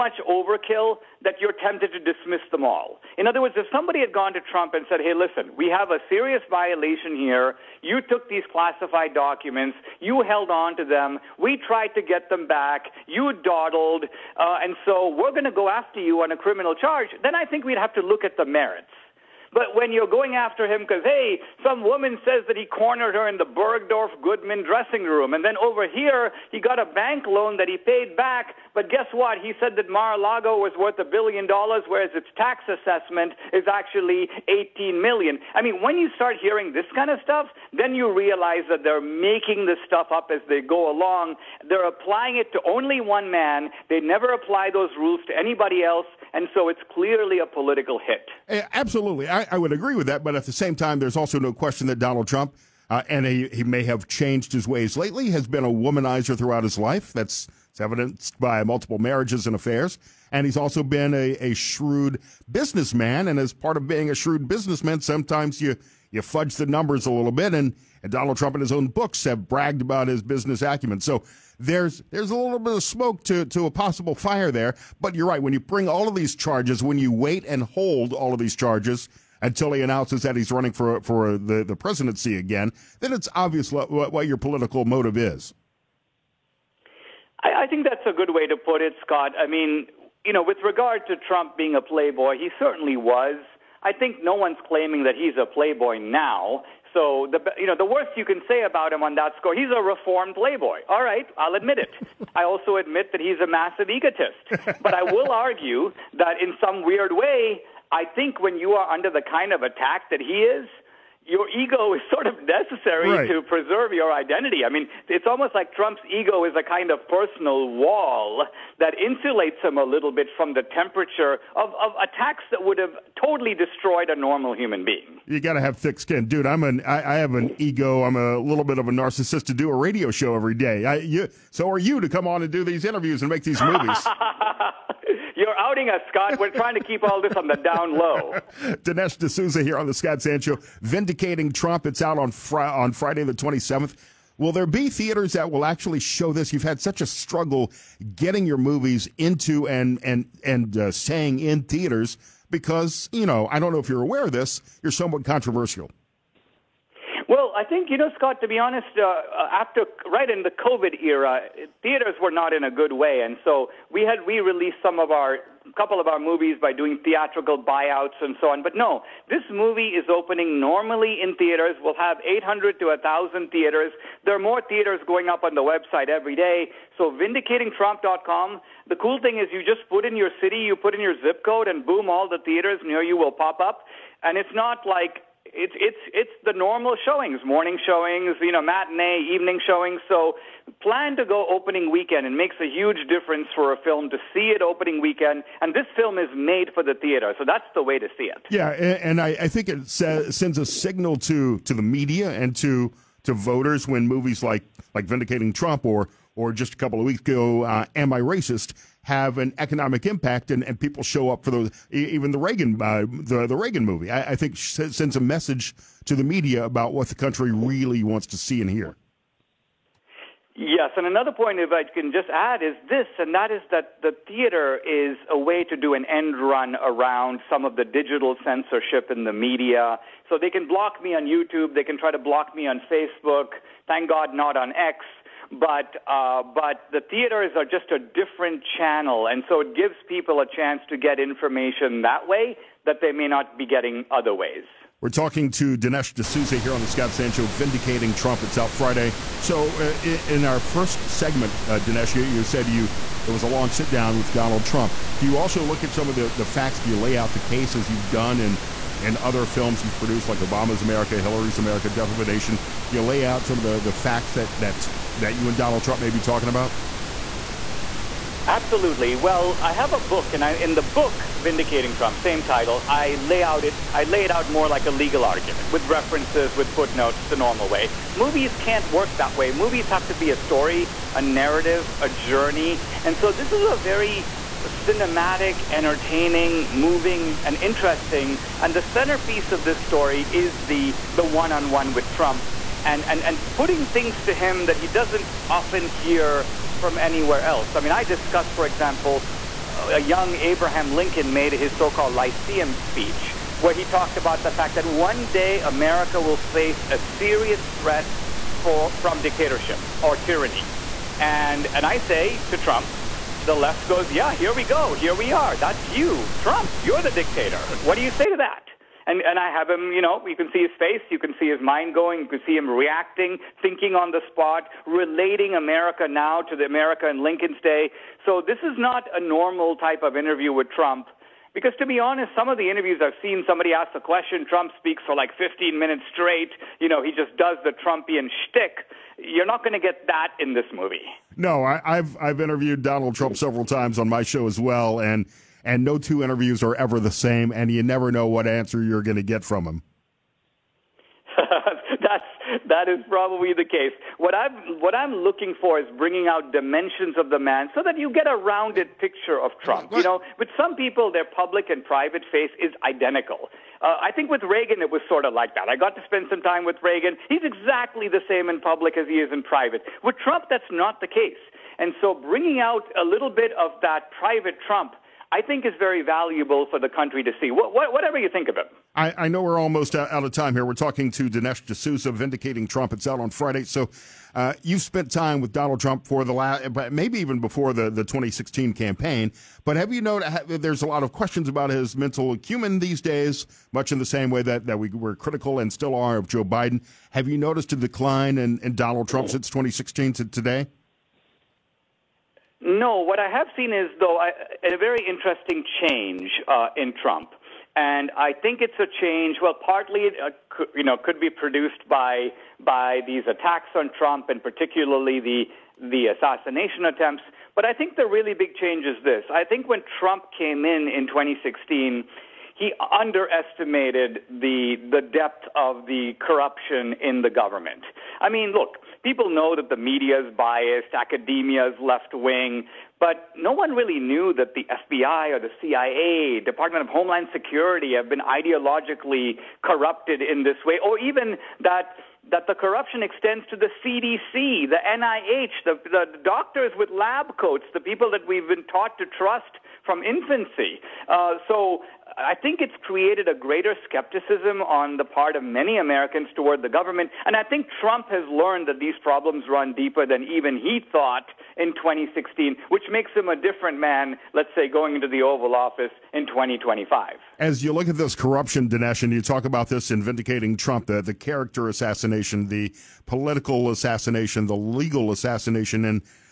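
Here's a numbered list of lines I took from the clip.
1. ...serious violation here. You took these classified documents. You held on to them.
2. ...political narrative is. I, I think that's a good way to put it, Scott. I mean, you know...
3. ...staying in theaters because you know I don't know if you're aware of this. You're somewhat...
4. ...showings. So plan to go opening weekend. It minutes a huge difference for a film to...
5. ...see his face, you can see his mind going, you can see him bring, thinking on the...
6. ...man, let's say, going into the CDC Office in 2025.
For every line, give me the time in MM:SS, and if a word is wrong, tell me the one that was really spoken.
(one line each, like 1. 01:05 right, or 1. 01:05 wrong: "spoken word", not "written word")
1. 00:06 right
2. 01:24 wrong: "motive", not "narrative"
3. 02:30 right
4. 03:09 wrong: "makes", not "minutes"
5. 05:20 wrong: "reacting", not "bring"
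6. 07:43 wrong: "Oval", not "CDC".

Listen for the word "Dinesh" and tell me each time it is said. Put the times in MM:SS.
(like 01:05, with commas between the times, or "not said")
02:18, 04:05, 04:11, 06:21, 07:48.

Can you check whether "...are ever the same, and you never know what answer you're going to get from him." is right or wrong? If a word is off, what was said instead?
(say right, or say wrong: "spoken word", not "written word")
right.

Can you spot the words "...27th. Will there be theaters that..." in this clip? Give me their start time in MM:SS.
02:23.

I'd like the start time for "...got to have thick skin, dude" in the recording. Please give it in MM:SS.
02:05.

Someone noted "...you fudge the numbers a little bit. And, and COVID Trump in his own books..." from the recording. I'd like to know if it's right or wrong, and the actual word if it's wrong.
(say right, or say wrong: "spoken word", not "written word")
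wrong: "Donald", not "COVID".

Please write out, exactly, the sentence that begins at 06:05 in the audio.
I got to spend some time with Reagan.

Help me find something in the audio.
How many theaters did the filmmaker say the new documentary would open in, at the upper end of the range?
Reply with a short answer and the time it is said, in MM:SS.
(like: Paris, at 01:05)
1,000, at 02:52.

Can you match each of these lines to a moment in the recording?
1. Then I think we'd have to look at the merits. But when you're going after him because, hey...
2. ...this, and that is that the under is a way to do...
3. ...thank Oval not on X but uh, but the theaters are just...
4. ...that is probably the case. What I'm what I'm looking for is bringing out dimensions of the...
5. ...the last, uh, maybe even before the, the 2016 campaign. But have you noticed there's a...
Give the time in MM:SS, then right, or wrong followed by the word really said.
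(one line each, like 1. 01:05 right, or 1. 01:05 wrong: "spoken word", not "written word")
1. 00:17 right
2. 03:42 wrong: "theater", not "under"
3. 03:53 wrong: "God", not "Oval"
4. 05:52 right
5. 06:26 right.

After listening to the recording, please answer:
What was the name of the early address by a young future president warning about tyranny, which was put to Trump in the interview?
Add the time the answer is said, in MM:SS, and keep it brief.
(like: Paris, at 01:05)
Lyceum speech, at 05:02.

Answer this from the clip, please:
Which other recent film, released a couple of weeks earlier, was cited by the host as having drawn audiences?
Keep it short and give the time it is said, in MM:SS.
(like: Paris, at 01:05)
Am I Racist?, at 03:27.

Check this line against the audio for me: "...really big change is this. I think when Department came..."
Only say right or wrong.
wrong.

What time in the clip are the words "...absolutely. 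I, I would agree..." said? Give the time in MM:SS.
00:48.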